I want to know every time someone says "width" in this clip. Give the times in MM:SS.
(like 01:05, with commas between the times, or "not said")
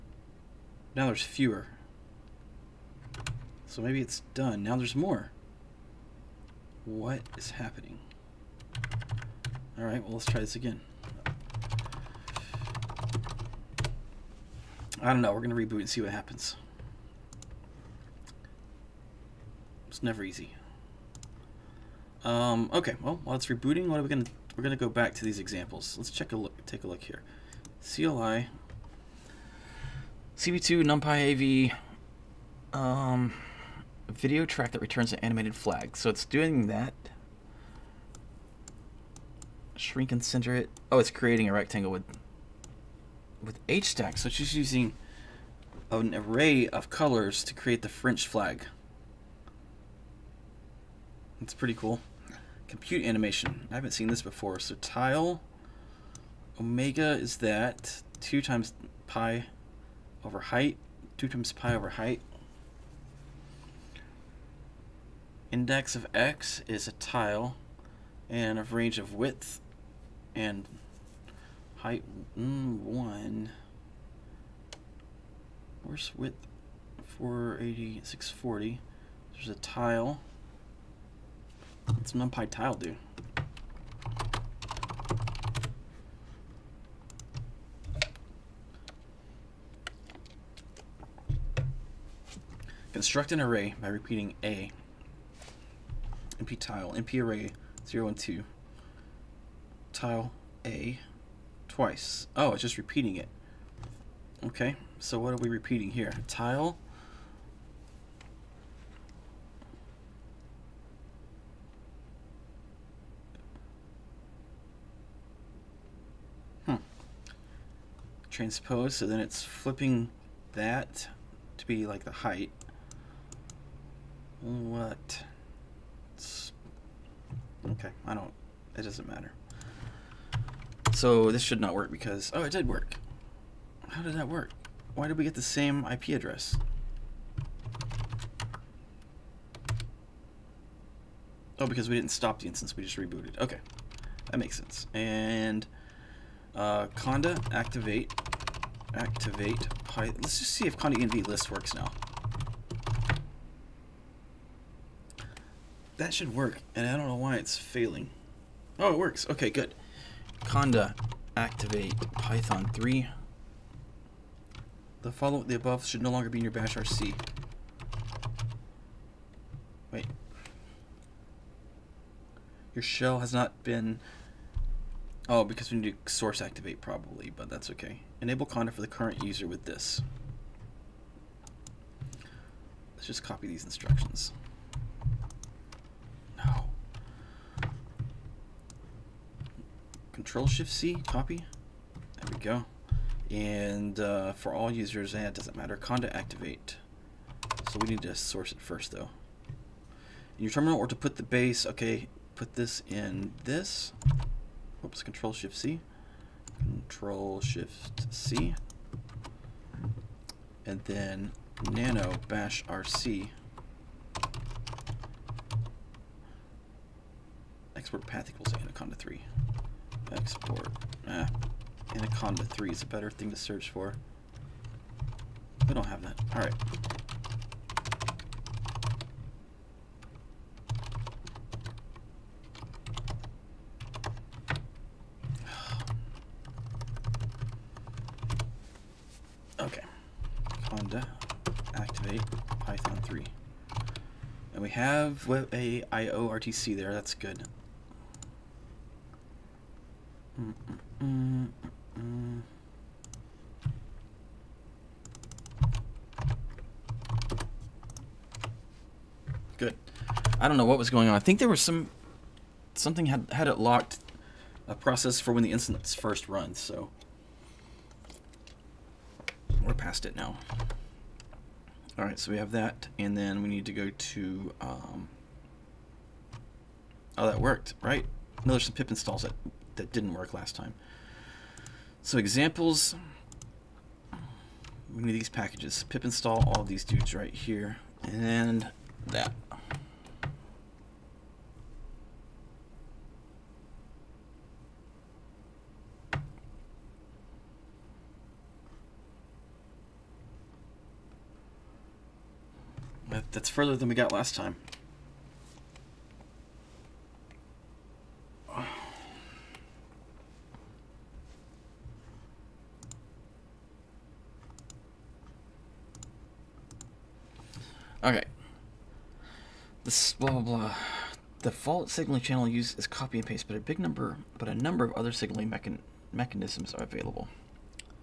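01:09, 01:16.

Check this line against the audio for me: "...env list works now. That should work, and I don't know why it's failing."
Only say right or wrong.
right.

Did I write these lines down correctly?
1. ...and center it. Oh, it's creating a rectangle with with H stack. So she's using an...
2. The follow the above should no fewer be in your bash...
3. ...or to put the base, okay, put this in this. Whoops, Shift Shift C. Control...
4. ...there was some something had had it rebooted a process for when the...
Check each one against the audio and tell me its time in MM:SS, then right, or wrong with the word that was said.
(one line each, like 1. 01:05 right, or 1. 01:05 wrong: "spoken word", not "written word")
1. 00:40 right
2. 02:45 wrong: "longer", not "fewer"
3. 03:20 wrong: "Control", not "Shift"
4. 04:21 wrong: "locked", not "rebooted".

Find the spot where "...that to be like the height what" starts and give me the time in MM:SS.
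02:00.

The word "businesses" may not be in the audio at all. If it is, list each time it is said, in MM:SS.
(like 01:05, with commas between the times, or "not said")
not said.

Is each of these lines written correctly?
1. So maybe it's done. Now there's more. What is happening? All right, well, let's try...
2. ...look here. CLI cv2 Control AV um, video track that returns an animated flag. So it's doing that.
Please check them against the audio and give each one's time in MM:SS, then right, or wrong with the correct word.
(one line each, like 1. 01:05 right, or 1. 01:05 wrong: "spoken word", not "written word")
1. 00:03 right
2. 00:26 wrong: "NumPy", not "Control".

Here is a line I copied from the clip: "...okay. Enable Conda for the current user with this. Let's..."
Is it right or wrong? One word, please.
right.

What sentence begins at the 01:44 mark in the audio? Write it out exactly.
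Okay, so what are we repeating here?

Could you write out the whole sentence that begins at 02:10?
So this should not work because, oh, it did work.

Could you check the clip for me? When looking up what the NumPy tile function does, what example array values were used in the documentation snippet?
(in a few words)
0 and 2.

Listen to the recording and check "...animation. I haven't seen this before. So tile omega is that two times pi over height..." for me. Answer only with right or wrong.
right.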